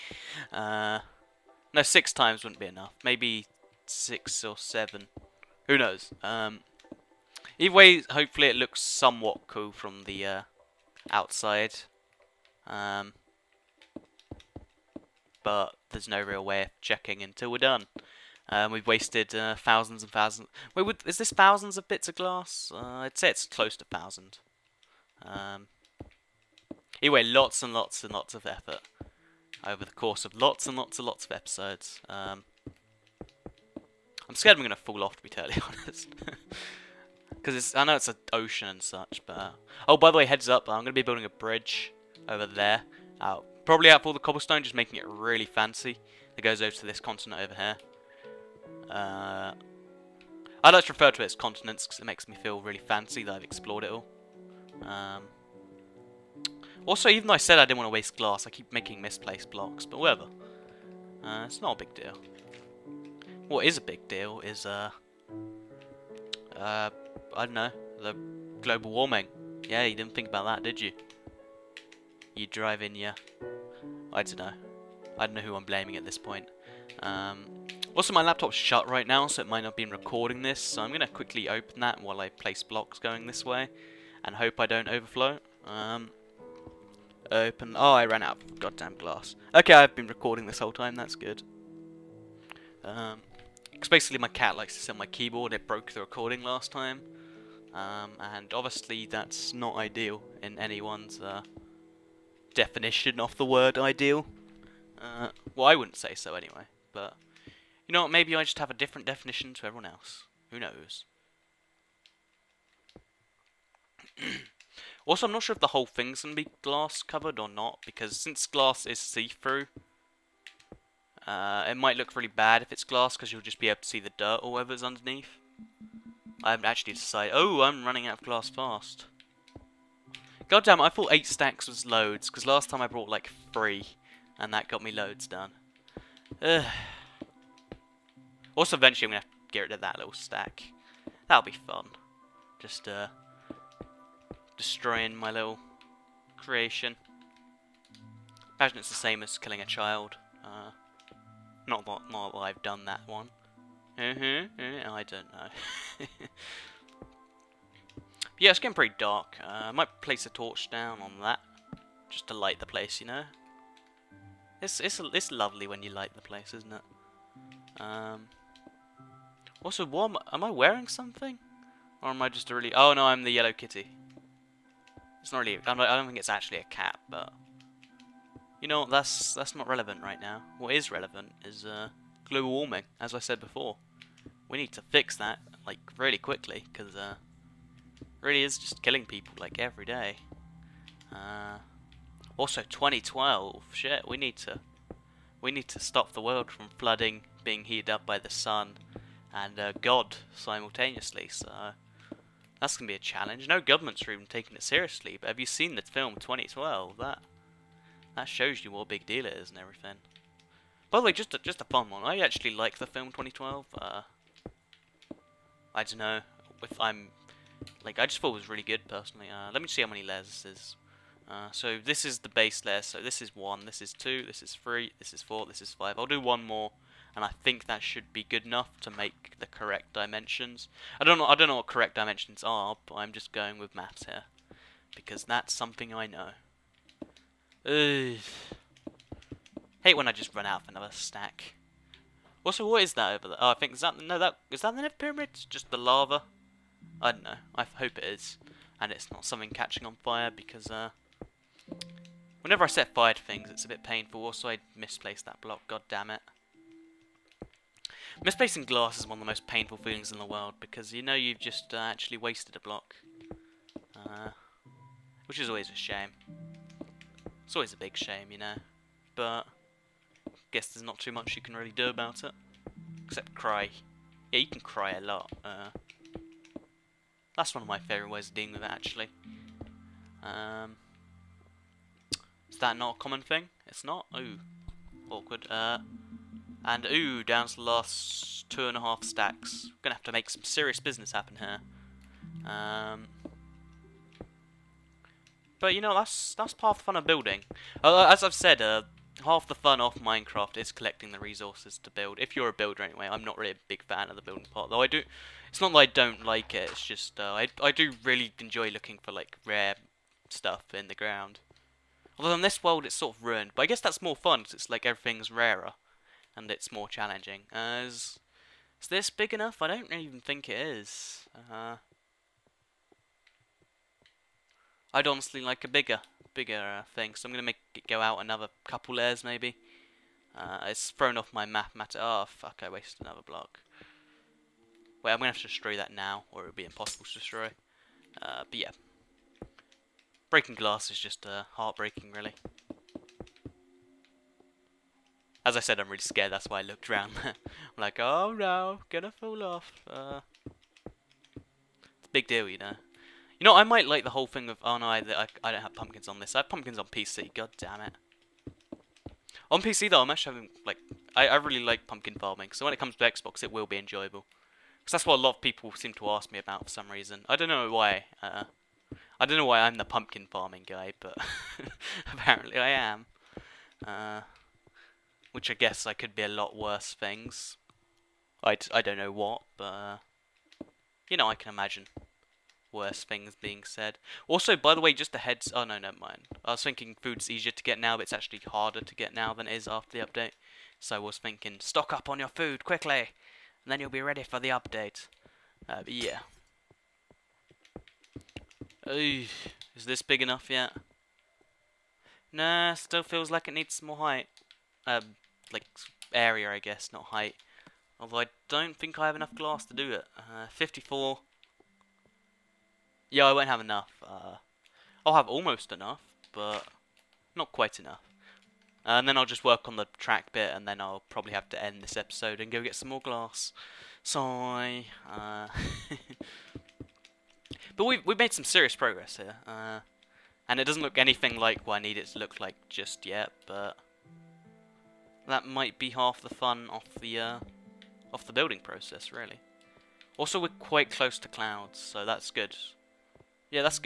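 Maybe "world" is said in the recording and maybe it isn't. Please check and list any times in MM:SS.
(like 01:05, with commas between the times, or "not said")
03:16, 04:20, 05:12.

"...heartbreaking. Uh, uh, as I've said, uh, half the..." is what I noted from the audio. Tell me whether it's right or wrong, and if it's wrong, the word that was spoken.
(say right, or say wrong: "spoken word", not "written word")
wrong: "building", not "heartbreaking".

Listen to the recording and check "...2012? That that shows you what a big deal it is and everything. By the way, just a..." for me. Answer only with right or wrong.
right.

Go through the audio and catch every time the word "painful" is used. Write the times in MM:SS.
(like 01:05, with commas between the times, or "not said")
04:13, 04:19.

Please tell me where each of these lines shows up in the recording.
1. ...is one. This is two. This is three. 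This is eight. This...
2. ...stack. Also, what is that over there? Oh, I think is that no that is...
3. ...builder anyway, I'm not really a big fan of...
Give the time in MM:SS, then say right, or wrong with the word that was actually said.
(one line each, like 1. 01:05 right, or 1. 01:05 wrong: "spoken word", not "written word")
1. 03:43 wrong: "four", not "eight"
2. 04:00 right
3. 05:02 right.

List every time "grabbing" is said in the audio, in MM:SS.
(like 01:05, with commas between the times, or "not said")
not said.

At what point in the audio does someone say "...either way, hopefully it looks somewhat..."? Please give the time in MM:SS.
00:07.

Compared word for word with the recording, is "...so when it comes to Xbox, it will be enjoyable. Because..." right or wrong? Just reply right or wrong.
right.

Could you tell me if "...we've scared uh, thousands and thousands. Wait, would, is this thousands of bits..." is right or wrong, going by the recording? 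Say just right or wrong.
wrong.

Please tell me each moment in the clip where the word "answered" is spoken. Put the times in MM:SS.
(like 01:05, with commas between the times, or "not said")
not said.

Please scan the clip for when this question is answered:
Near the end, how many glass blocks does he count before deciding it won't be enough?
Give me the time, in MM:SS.
06:50.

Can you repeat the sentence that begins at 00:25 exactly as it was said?
Um, anyway, lots and lots and lots of effort over the course of lots and lots and lots of episodes.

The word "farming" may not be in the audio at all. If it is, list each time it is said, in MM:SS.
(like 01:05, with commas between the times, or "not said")
06:02, 06:10.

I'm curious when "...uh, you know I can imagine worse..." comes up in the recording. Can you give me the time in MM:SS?
06:19.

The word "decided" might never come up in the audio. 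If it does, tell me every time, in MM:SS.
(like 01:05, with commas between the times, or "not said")
02:06.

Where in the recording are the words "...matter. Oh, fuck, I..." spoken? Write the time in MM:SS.
05:31.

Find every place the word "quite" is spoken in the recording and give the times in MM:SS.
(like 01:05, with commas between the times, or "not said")
06:57, 07:20.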